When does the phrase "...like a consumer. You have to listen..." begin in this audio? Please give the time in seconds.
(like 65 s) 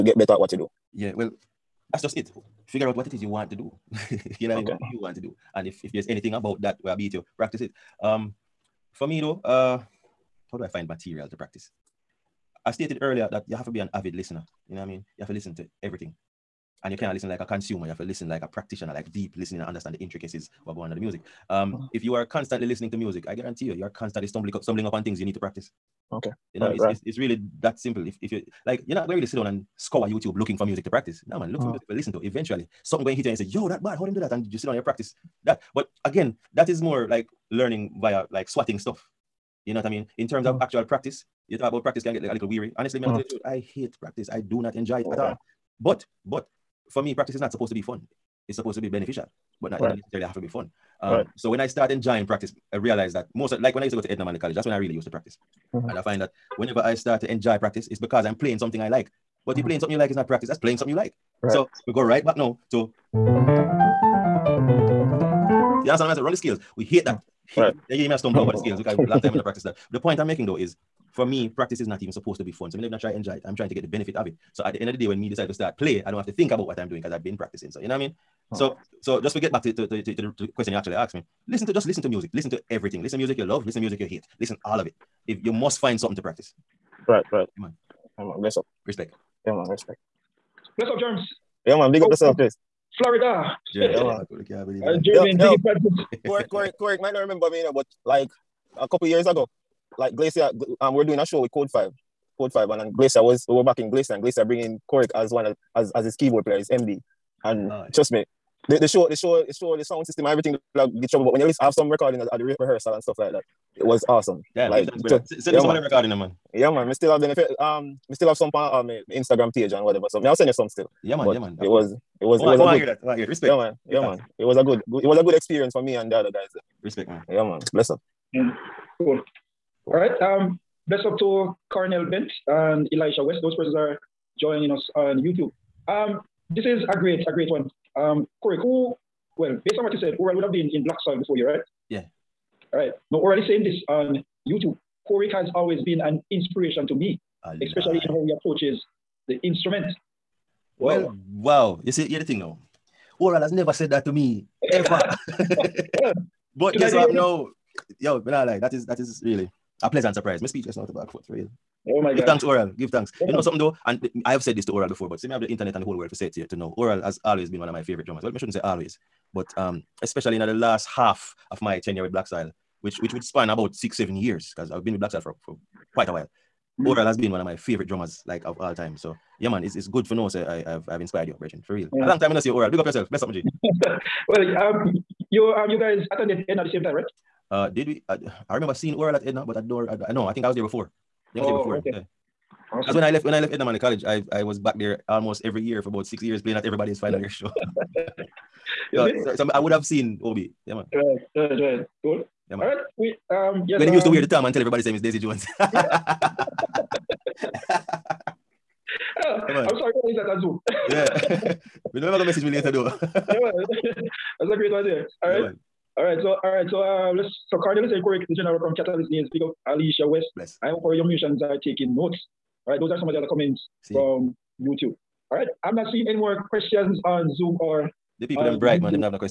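17 s.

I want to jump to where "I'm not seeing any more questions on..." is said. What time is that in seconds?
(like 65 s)
225 s.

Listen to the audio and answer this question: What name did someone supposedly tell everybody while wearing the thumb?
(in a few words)
Daisy Jones.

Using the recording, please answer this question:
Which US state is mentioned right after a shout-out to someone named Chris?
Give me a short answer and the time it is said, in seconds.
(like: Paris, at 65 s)
Florida, at 92 s.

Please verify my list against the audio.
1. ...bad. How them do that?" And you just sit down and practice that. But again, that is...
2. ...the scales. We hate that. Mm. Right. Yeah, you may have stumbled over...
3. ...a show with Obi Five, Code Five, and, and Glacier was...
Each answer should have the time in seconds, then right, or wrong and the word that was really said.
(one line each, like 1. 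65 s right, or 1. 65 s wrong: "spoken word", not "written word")
1. 33 s right
2. 66 s right
3. 101 s wrong: "Code", not "Obi".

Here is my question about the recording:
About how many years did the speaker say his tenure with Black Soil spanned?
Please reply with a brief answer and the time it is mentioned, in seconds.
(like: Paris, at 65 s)
6 or 7 years, at 173 s.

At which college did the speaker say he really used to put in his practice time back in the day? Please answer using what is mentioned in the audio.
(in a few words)
Edna Manley College.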